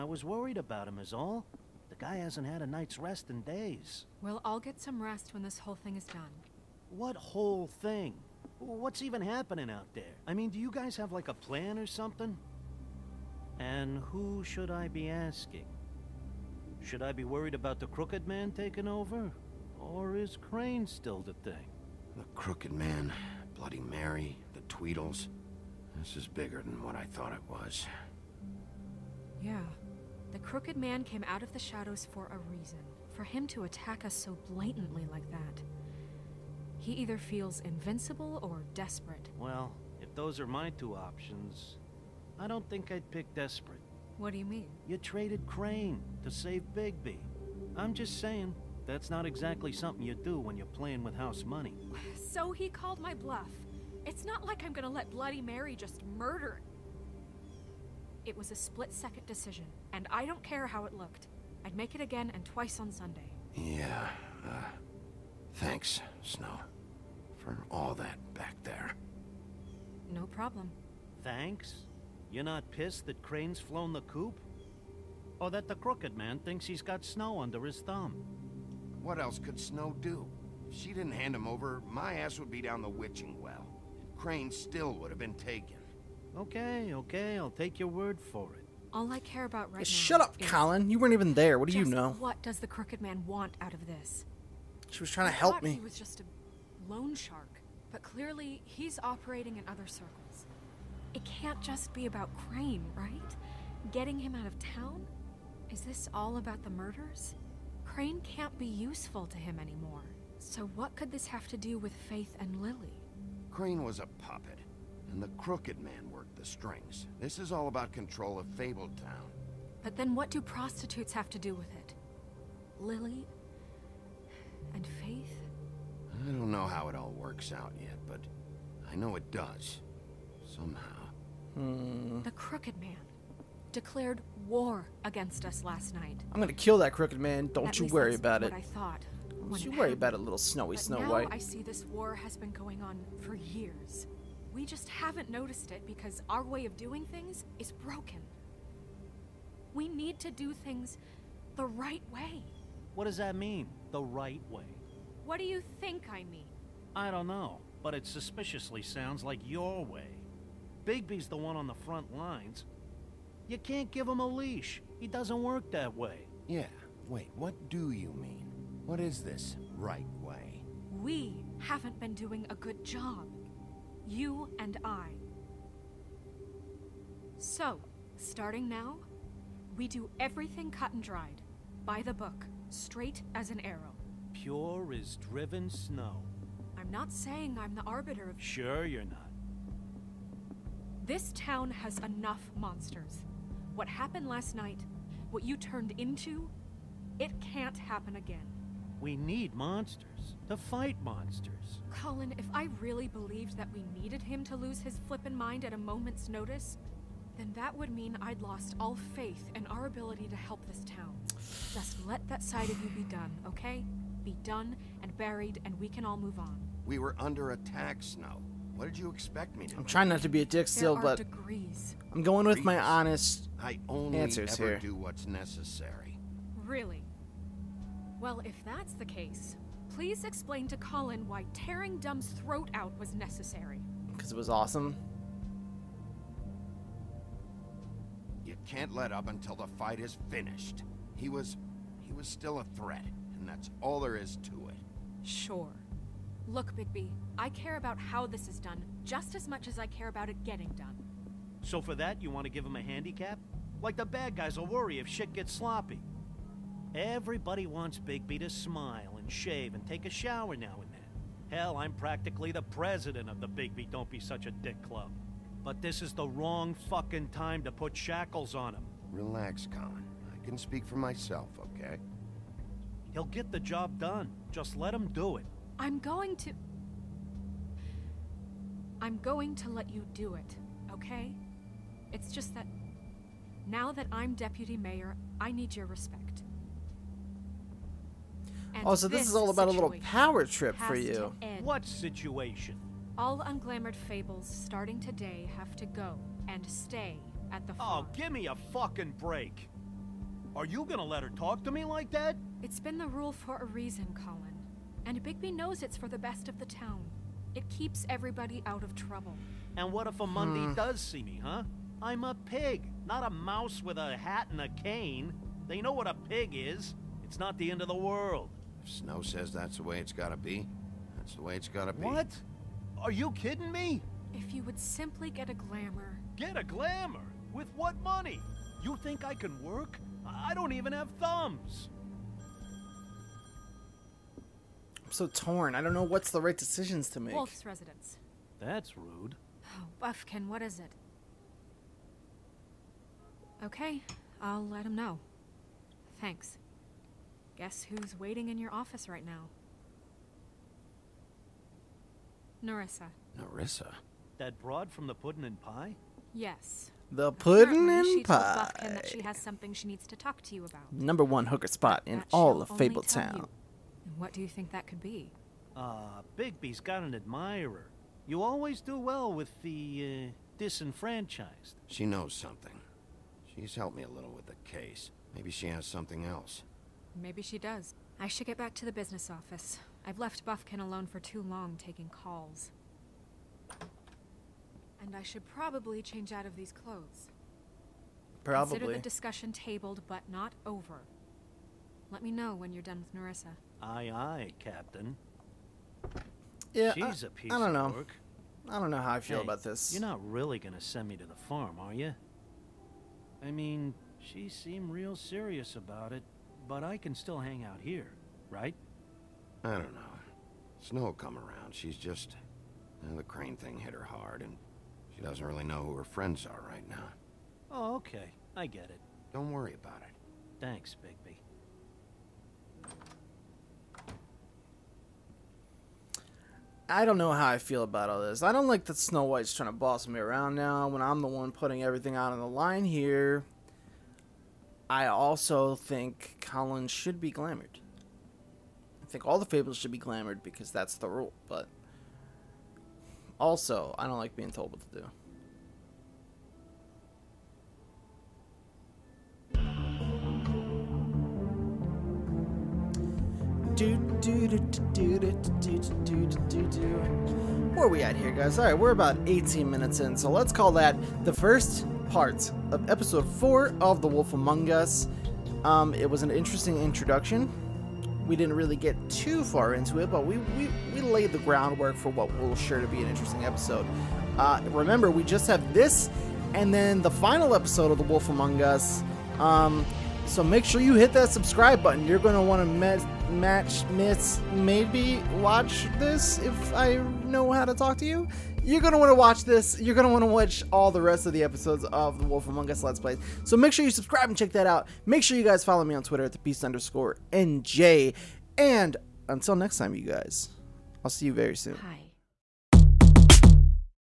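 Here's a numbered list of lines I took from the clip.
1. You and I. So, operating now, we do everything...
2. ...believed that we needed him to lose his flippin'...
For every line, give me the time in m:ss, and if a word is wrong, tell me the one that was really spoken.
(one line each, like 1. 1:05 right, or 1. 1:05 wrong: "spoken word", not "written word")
1. 2:54 wrong: "starting", not "operating"
2. 3:23 right.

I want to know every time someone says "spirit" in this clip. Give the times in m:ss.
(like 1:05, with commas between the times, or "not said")
not said.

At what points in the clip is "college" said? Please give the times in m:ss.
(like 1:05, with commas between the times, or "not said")
not said.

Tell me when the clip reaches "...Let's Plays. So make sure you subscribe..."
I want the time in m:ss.
8:12.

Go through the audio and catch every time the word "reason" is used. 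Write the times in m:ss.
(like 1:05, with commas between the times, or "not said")
0:32, 5:03.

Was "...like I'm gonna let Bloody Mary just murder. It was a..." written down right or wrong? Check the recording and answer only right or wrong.
right.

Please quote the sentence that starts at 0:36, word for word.
He either feels invincible or desperate.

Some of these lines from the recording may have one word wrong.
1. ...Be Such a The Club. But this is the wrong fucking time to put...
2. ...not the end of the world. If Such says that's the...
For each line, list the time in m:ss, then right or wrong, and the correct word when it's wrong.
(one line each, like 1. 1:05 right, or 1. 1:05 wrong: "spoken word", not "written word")
1. 4:24 wrong: "Dick", not "The"
2. 5:17 wrong: "Snow", not "Such".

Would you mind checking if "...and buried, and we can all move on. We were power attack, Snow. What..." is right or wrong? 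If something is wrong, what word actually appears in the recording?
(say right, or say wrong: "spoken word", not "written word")
wrong: "under", not "power".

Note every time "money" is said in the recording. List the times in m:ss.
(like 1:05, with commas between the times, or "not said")
0:51, 5:28.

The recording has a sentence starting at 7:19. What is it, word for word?
I think all the fables should be glamored because that's the rule, but also, I don't like being told what to do.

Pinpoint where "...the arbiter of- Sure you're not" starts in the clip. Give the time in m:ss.
3:07.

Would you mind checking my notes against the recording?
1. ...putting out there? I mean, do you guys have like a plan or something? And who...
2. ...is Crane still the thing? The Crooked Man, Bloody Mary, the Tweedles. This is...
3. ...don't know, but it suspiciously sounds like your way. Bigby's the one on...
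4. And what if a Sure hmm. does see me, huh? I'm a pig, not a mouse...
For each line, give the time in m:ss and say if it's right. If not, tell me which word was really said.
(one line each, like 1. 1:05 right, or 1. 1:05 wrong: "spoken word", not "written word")
1. 0:09 wrong: "happening", not "putting"
2. 0:20 right
3. 2:37 right
4. 5:09 wrong: "Mundy", not "Sure".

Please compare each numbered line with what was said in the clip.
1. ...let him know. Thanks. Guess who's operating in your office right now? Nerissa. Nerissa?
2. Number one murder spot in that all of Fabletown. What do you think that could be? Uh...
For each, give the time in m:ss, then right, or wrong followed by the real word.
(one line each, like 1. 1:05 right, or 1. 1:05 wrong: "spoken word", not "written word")
1. 5:44 wrong: "waiting", not "operating"
2. 6:00 wrong: "hooker", not "murder".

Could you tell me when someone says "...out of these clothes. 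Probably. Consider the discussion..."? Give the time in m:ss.
6:26.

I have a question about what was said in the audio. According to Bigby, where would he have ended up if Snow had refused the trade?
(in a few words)
Witching well.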